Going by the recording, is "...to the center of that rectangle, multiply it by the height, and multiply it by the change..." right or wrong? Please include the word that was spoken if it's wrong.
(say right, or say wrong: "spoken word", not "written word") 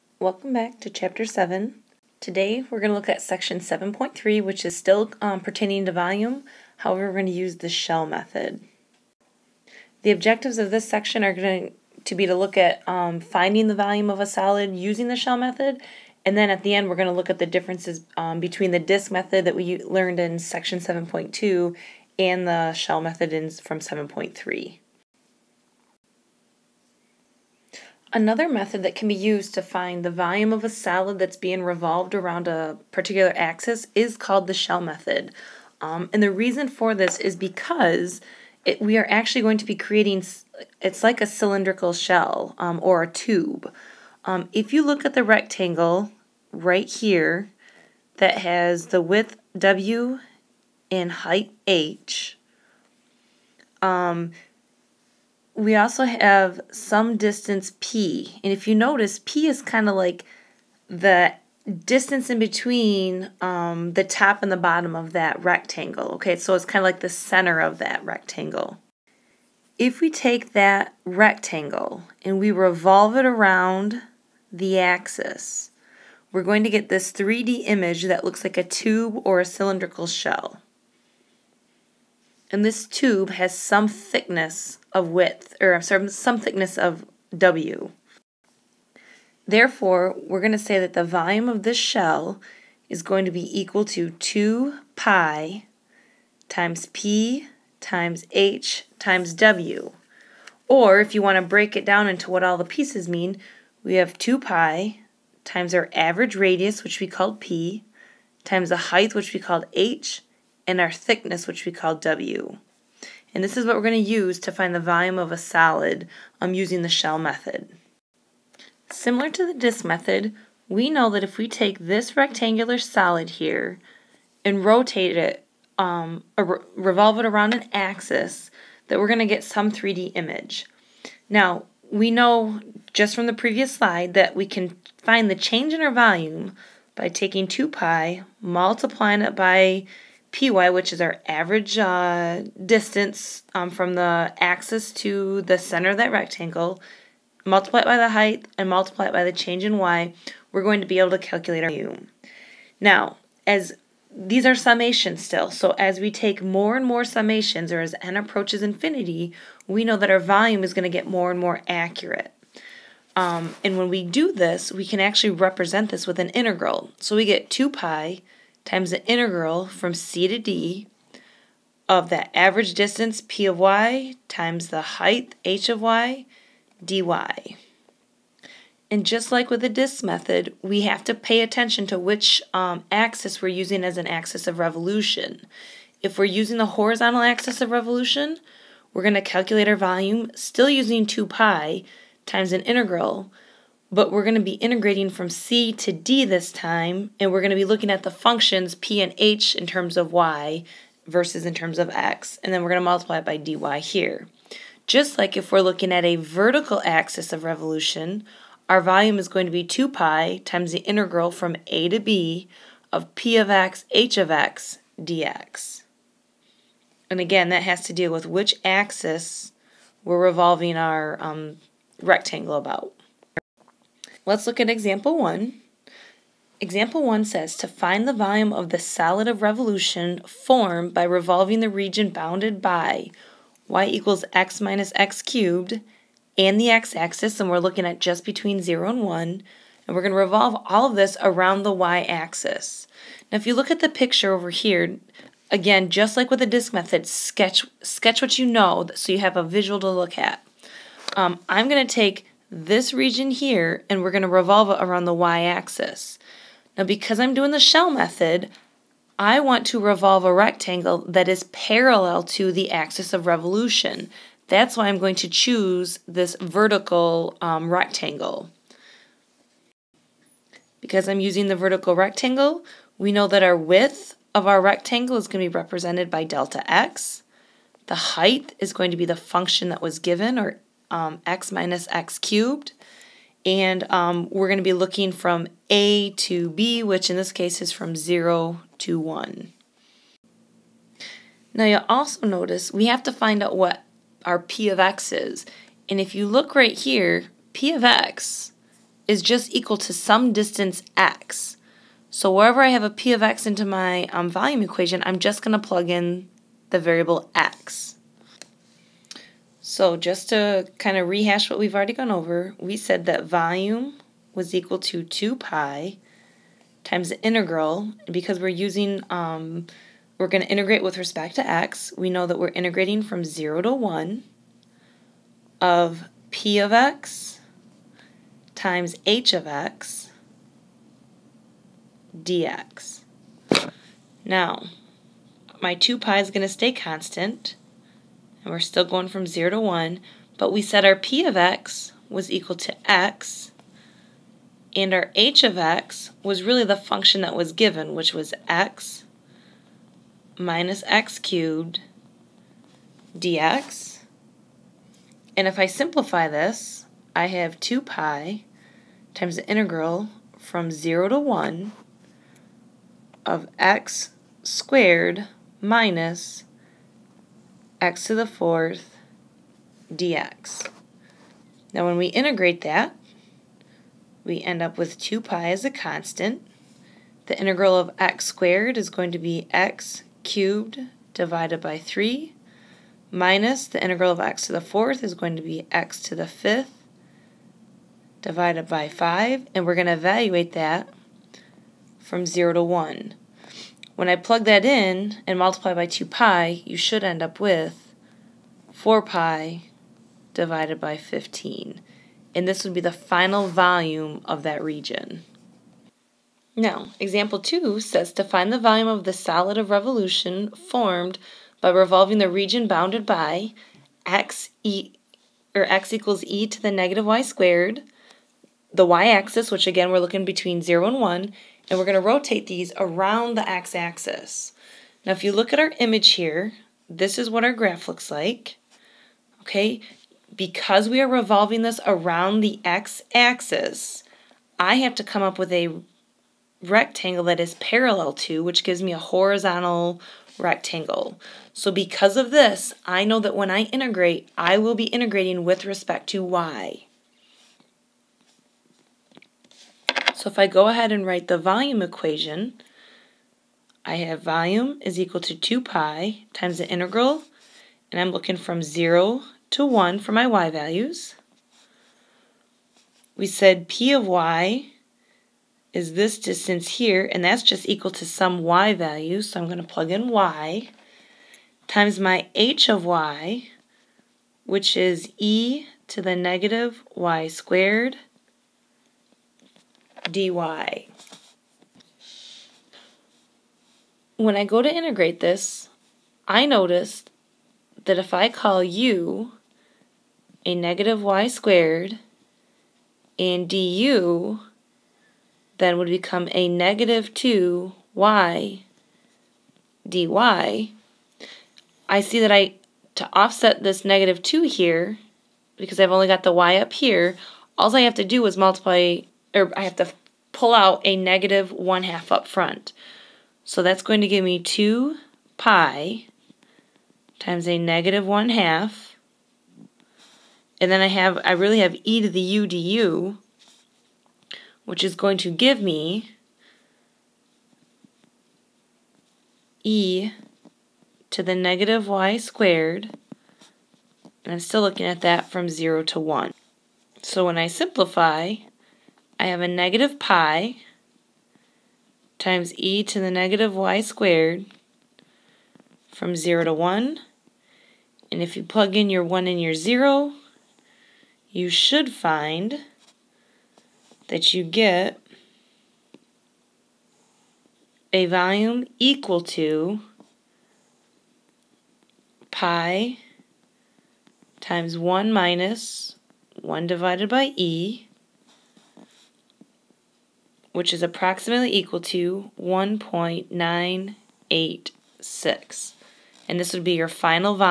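right.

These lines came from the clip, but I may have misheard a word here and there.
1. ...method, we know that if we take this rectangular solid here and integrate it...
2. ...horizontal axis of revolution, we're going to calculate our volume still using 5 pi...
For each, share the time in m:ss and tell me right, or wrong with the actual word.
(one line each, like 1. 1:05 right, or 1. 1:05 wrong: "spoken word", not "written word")
1. 1:59 wrong: "rotate", not "integrate"
2. 3:06 wrong: "2", not "5".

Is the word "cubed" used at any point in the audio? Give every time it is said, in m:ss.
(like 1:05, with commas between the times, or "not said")
3:55, 4:42, 5:51, 6:20.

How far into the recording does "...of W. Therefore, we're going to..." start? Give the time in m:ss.
1:26.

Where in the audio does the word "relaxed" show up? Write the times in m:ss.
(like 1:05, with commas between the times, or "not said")
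not said.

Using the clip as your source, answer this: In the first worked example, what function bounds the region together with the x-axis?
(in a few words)
y = x - x^3.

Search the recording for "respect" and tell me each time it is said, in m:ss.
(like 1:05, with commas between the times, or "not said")
5:20, 7:25.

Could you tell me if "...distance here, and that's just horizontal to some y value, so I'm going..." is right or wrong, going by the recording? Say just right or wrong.
wrong.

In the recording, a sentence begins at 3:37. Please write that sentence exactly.
And again, that has to deal with which axis we're revolving our um, rectangle about.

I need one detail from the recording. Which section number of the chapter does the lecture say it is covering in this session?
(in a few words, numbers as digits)
7.3.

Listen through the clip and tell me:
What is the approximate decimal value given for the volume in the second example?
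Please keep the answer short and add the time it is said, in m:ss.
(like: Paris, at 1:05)
1.986, at 9:32.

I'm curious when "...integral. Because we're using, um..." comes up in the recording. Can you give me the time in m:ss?
5:17.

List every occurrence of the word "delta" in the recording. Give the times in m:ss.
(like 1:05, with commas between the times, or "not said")
4:36.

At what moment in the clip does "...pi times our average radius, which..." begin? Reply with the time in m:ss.
1:44.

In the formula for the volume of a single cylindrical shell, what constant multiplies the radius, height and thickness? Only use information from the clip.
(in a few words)
2 pi.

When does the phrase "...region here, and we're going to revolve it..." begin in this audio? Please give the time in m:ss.
4:12.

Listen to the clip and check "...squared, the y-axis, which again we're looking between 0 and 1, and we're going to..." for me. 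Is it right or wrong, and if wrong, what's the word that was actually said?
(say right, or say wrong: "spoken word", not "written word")
right.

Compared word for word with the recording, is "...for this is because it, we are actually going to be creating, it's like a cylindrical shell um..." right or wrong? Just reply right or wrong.
right.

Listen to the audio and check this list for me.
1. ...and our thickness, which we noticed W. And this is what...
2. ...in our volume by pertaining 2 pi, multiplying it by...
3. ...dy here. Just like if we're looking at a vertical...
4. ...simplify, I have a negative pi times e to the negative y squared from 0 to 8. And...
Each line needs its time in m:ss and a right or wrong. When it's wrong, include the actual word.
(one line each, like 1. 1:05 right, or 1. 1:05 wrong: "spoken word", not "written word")
1. 1:50 wrong: "called", not "noticed"
2. 2:15 wrong: "taking", not "pertaining"
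3. 3:23 right
4. 8:57 wrong: "1", not "8".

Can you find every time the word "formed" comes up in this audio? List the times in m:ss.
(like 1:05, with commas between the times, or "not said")
3:50, 6:50.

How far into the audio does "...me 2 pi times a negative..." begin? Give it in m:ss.
8:34.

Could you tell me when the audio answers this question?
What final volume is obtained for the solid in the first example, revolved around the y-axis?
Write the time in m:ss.
6:38.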